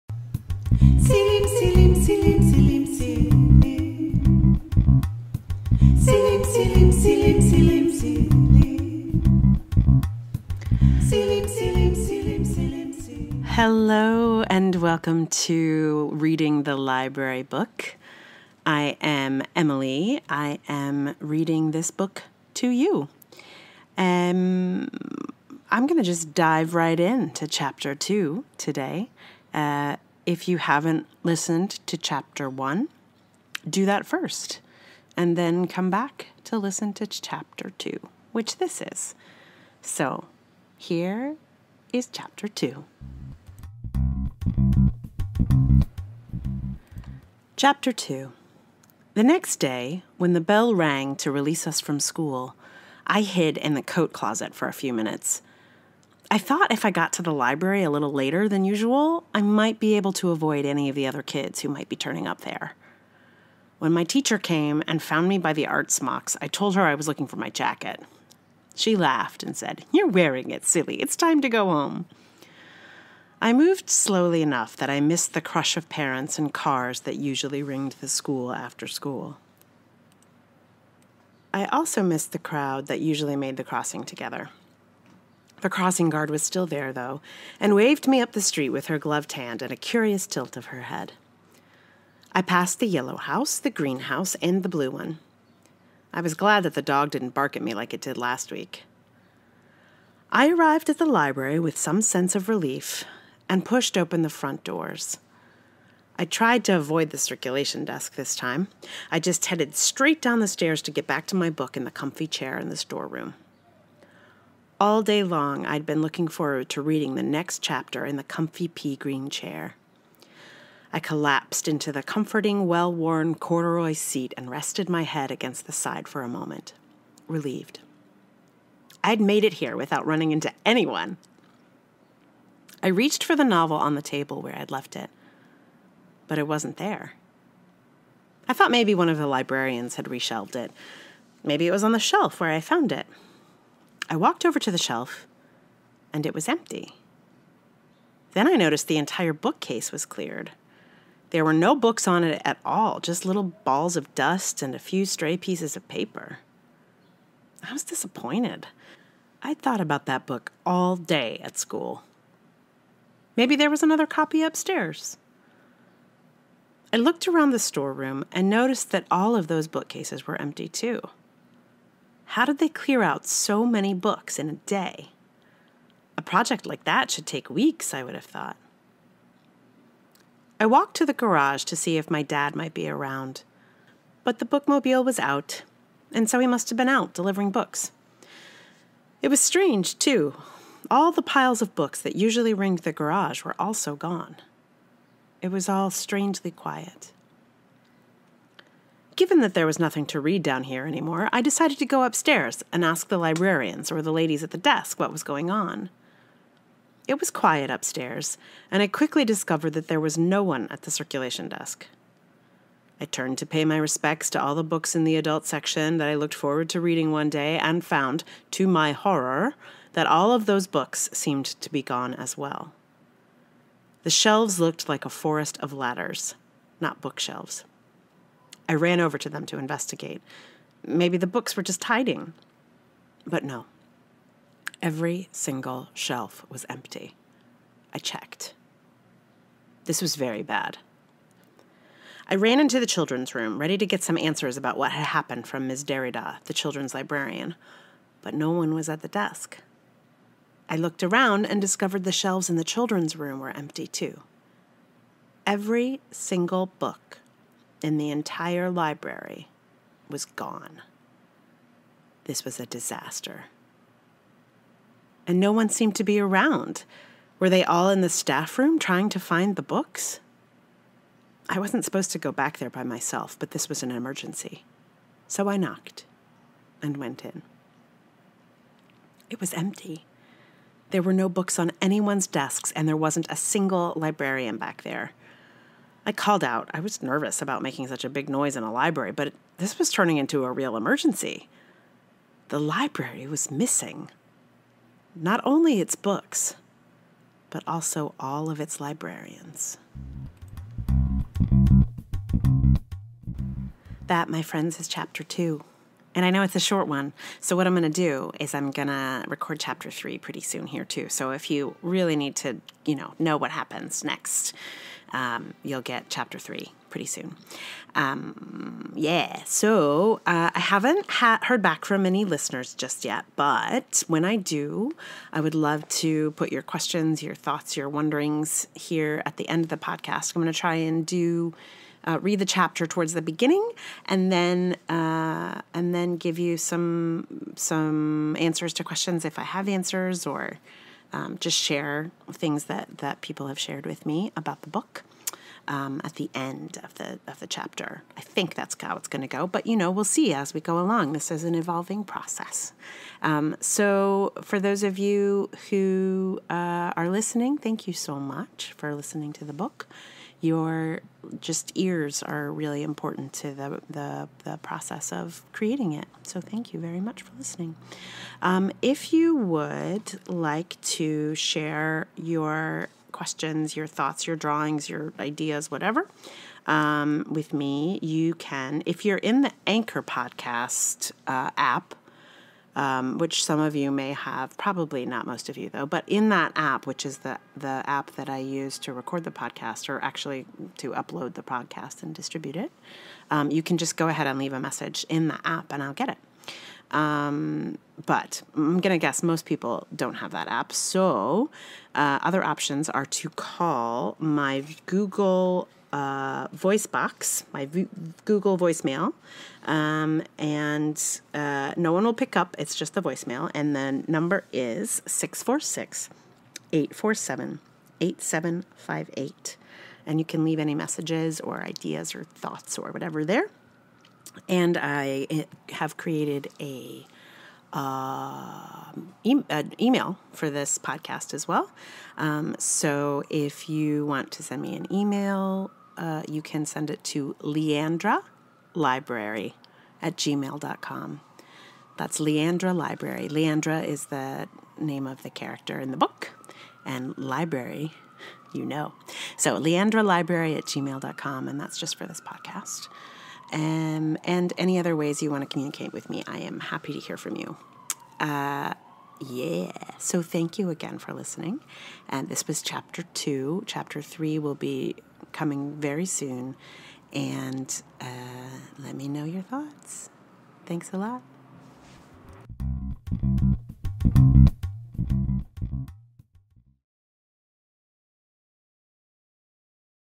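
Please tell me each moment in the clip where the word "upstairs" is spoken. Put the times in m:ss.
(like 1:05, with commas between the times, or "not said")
2:44, 3:22, 3:27.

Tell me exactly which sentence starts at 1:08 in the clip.
She laughed and said, You're wearing it, silly.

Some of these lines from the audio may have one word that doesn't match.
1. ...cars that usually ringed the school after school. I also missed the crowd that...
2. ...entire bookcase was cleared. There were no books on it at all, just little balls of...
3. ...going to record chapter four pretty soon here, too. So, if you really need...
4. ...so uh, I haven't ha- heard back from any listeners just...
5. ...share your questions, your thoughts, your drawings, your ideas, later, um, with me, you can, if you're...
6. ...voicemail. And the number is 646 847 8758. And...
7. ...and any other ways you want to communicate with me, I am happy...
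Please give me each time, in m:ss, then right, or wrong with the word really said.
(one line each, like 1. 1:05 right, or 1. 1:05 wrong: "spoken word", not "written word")
1. 1:16 right
2. 2:28 right
3. 5:08 wrong: "three", not "four"
4. 5:19 right
5. 6:11 wrong: "whatever", not "later"
6. 6:53 right
7. 7:34 right.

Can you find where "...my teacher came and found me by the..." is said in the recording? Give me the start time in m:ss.
1:03.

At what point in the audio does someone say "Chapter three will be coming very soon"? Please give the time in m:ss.
7:43.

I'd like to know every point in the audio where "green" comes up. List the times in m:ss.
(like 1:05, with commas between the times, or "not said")
1:33, 1:58.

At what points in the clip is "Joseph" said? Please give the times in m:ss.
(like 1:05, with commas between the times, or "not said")
not said.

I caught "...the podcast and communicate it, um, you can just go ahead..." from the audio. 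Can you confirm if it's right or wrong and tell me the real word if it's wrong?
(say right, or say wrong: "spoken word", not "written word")
wrong: "distribute", not "communicate".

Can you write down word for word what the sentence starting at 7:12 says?
Um, so if you want to send me an email uh, you can send it to Leandra Library at gmail.com.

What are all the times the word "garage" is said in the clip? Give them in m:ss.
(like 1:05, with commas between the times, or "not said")
3:01, 3:12.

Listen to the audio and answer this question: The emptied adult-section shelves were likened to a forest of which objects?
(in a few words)
Ladders.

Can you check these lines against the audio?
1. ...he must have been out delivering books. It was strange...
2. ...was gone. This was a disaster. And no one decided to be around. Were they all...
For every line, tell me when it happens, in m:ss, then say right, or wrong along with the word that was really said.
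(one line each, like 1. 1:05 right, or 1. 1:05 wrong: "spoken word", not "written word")
1. 3:06 right
2. 4:20 wrong: "seemed", not "decided".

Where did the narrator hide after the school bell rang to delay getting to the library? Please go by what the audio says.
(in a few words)
The coat closet.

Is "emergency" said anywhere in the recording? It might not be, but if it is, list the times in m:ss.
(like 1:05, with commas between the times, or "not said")
4:33, 4:50.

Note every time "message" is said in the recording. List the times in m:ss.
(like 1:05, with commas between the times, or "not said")
6:34, 7:00.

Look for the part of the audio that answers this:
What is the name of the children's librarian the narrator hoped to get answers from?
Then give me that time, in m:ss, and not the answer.
4:05.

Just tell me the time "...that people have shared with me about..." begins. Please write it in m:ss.
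5:42.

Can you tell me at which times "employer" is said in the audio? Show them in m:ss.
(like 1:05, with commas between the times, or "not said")
not said.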